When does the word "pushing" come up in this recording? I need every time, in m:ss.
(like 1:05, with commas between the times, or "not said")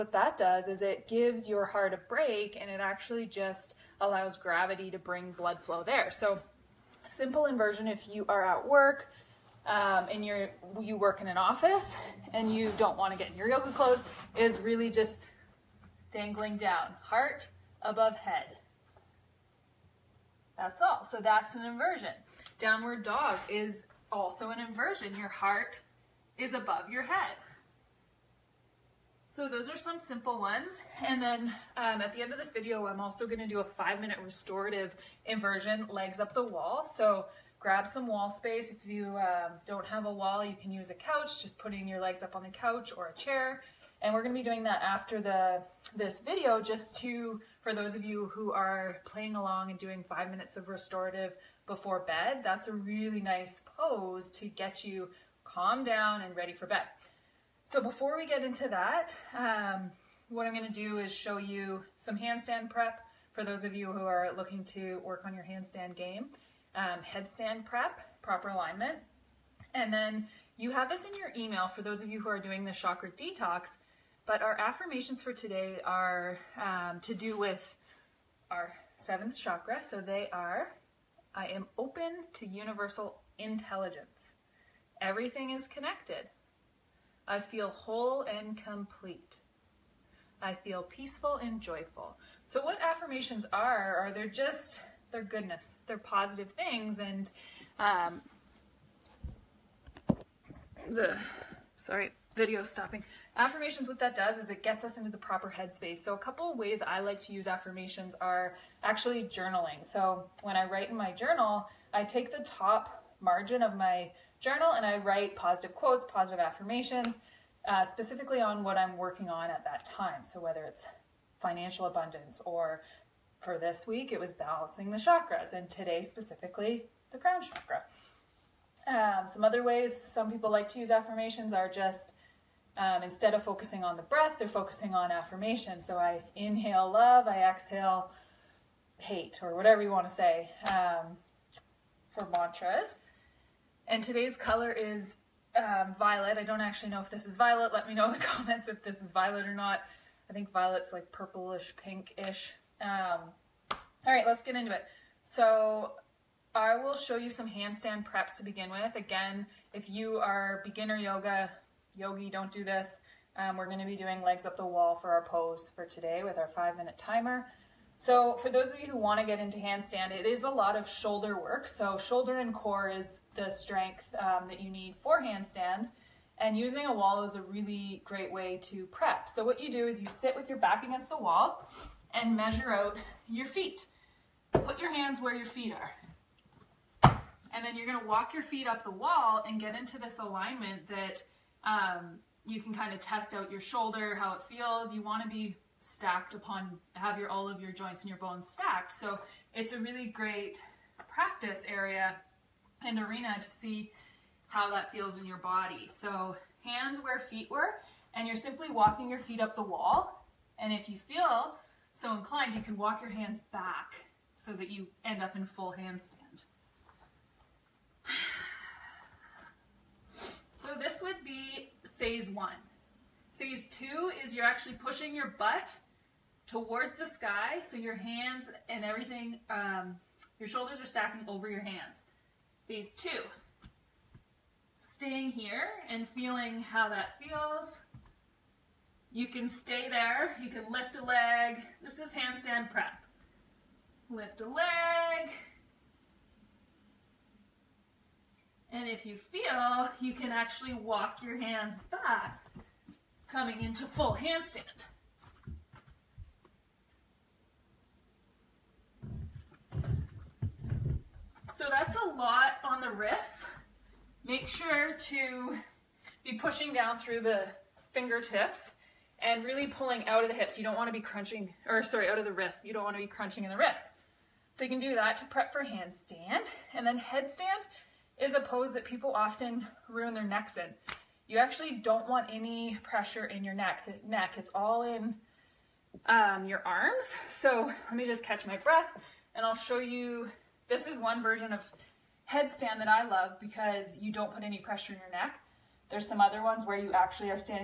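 3:44, 4:26.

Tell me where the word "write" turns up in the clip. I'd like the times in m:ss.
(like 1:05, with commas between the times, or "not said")
1:50, 1:54.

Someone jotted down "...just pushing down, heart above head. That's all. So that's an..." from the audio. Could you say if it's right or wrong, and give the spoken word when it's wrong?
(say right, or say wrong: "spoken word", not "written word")
wrong: "dangling", not "pushing".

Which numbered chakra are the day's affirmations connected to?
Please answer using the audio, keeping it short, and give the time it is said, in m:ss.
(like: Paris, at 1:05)
Seventh, at 1:18.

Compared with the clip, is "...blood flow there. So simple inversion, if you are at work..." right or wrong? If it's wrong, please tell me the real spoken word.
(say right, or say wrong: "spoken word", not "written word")
right.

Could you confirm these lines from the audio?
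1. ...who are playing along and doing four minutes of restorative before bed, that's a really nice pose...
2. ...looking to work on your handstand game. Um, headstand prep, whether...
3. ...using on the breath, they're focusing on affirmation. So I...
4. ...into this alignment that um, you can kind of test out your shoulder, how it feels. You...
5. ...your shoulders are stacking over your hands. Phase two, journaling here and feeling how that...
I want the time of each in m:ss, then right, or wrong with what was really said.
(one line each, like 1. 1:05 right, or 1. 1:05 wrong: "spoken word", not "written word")
1. 0:48 wrong: "five", not "four"
2. 1:04 wrong: "proper", not "whether"
3. 2:13 wrong: "focusing", not "using"
4. 3:09 right
5. 3:50 wrong: "staying", not "journaling".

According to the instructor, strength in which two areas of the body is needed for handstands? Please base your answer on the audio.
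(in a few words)
Shoulder and core.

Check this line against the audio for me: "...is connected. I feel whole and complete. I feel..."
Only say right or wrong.
right.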